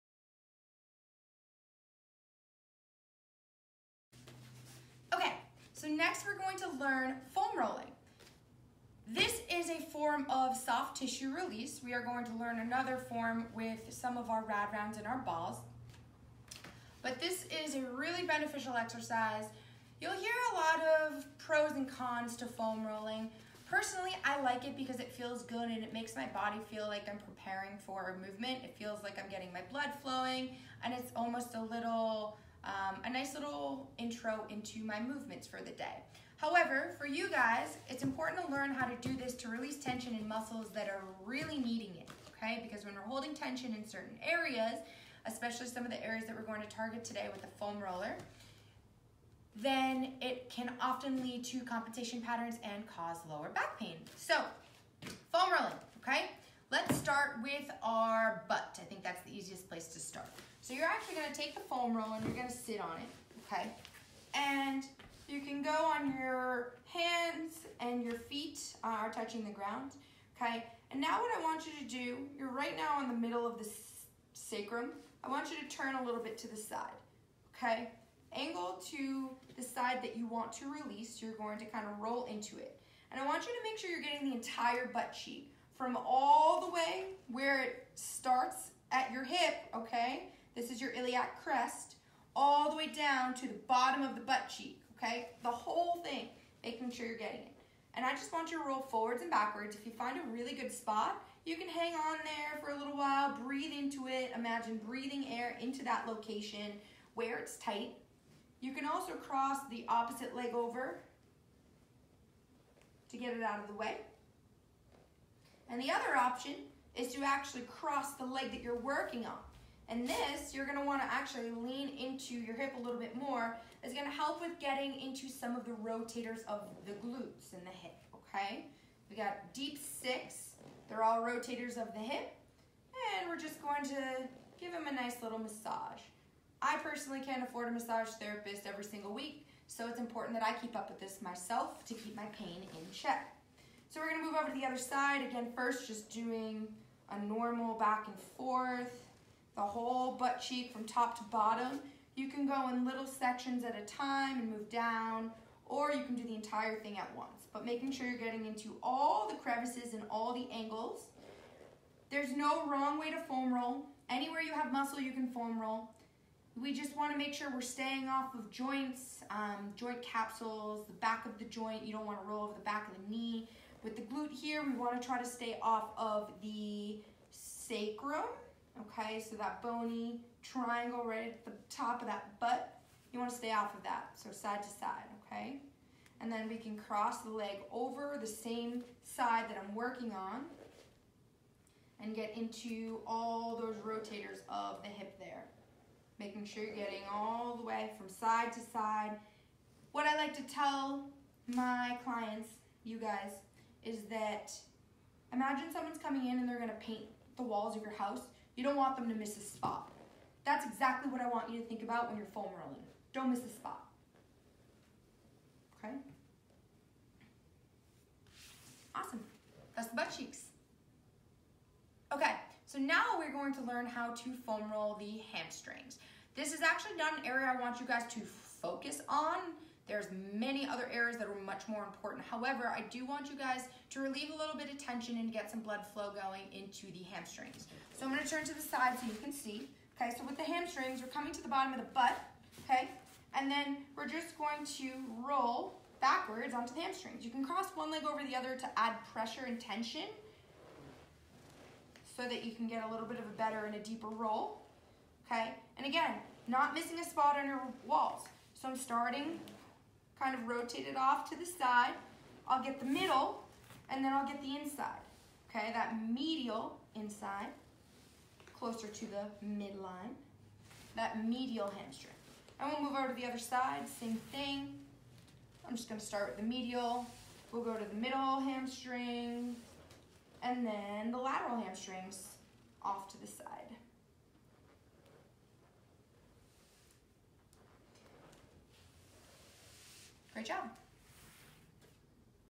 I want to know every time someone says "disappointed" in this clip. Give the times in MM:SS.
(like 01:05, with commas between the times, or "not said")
not said.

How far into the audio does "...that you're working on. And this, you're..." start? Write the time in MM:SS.
01:58.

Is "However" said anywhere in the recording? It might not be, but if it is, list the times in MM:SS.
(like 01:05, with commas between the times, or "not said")
00:36, 03:52.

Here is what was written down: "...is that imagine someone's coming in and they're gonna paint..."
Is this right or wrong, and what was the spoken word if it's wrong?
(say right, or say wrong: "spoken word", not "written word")
right.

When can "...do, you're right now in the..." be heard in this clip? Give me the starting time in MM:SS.
01:11.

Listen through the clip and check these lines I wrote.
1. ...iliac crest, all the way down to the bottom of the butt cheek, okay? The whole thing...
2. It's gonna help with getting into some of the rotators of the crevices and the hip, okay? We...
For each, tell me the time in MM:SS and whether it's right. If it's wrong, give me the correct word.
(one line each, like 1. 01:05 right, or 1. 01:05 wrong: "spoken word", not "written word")
1. 01:30 right
2. 02:03 wrong: "glutes", not "crevices".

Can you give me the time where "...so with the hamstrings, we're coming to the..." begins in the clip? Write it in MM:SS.
04:00.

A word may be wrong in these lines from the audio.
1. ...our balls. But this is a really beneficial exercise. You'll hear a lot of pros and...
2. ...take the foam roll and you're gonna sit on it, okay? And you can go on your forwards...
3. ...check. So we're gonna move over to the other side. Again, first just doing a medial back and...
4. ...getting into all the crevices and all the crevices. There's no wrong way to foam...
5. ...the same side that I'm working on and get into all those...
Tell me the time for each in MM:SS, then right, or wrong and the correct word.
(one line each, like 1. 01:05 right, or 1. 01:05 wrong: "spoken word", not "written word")
1. 00:15 right
2. 01:01 wrong: "hands", not "forwards"
3. 02:22 wrong: "normal", not "medial"
4. 02:38 wrong: "angles", not "crevices"
5. 03:08 right.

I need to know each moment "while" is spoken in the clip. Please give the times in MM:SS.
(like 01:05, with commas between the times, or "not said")
01:42.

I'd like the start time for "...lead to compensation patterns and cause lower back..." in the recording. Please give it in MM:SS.
00:51.